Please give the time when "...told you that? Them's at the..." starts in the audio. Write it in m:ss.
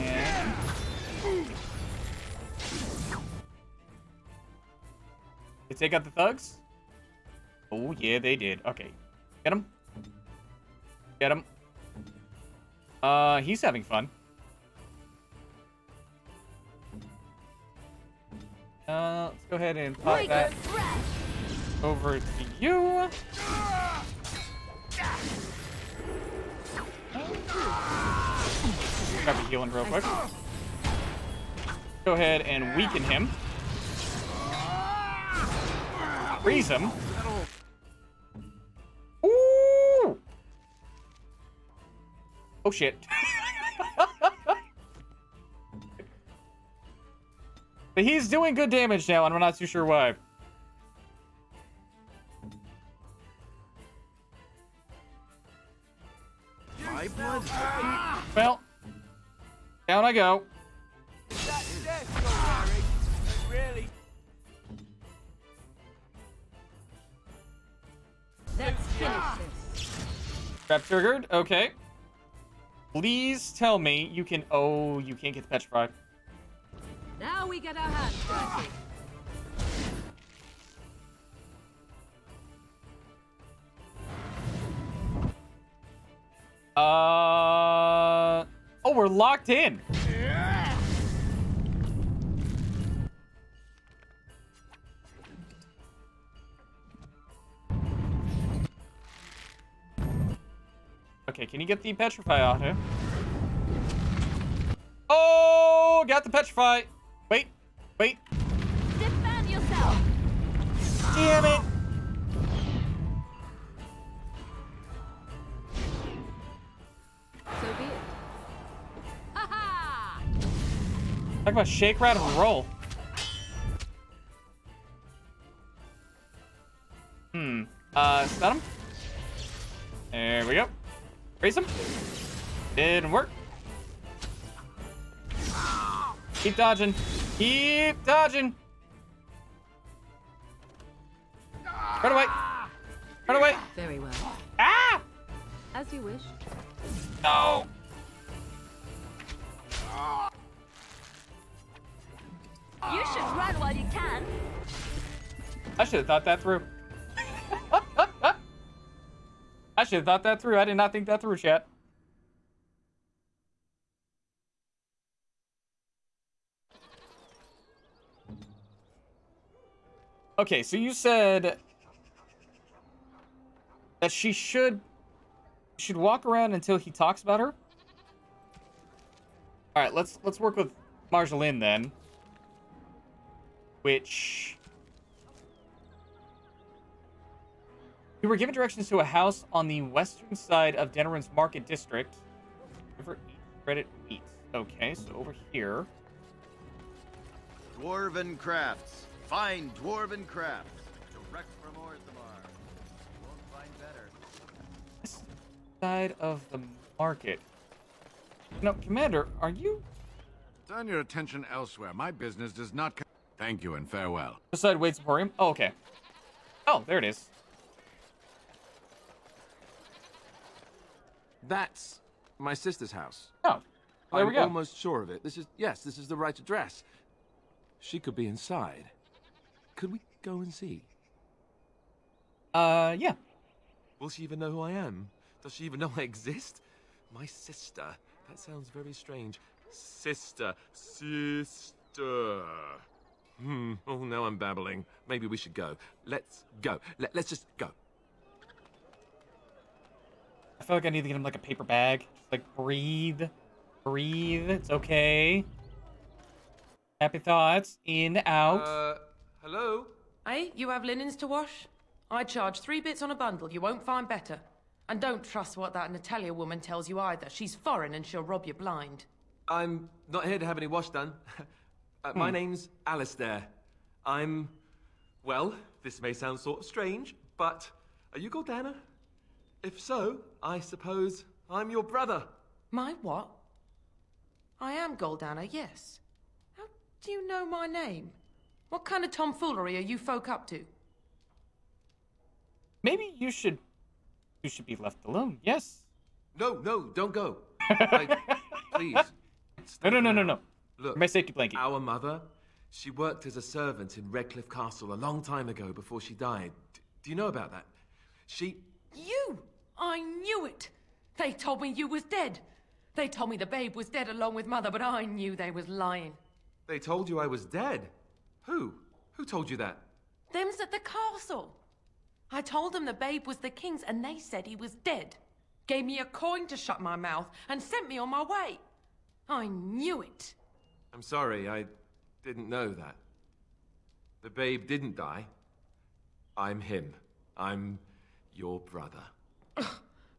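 5:19.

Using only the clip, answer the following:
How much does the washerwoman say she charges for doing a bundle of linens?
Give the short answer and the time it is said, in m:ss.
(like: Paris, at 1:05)
three bits, at 4:22.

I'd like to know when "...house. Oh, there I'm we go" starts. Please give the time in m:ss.
3:42.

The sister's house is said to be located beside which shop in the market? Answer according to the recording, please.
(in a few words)
Wade's Emporium.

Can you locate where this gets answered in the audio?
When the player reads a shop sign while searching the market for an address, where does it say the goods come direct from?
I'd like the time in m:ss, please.
3:21.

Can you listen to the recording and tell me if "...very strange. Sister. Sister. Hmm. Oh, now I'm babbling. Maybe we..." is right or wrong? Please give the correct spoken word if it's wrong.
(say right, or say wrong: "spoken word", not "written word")
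right.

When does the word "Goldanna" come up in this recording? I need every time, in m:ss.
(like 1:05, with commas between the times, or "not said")
4:38, 4:44.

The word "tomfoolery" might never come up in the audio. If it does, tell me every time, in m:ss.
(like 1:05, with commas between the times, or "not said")
4:49.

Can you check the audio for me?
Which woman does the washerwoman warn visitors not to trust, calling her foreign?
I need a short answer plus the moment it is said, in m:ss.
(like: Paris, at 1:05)
Natalia, at 4:25.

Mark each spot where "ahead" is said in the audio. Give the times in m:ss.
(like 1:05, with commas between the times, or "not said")
0:19, 0:32.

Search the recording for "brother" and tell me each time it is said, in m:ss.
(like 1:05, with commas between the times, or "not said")
4:41, 5:38.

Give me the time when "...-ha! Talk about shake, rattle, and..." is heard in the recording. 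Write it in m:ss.
1:59.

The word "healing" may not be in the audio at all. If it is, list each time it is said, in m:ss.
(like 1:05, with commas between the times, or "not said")
0:29.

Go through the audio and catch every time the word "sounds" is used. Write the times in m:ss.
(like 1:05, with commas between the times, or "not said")
3:58, 4:36.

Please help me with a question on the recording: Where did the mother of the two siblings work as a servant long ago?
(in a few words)
Redcliffe Castle.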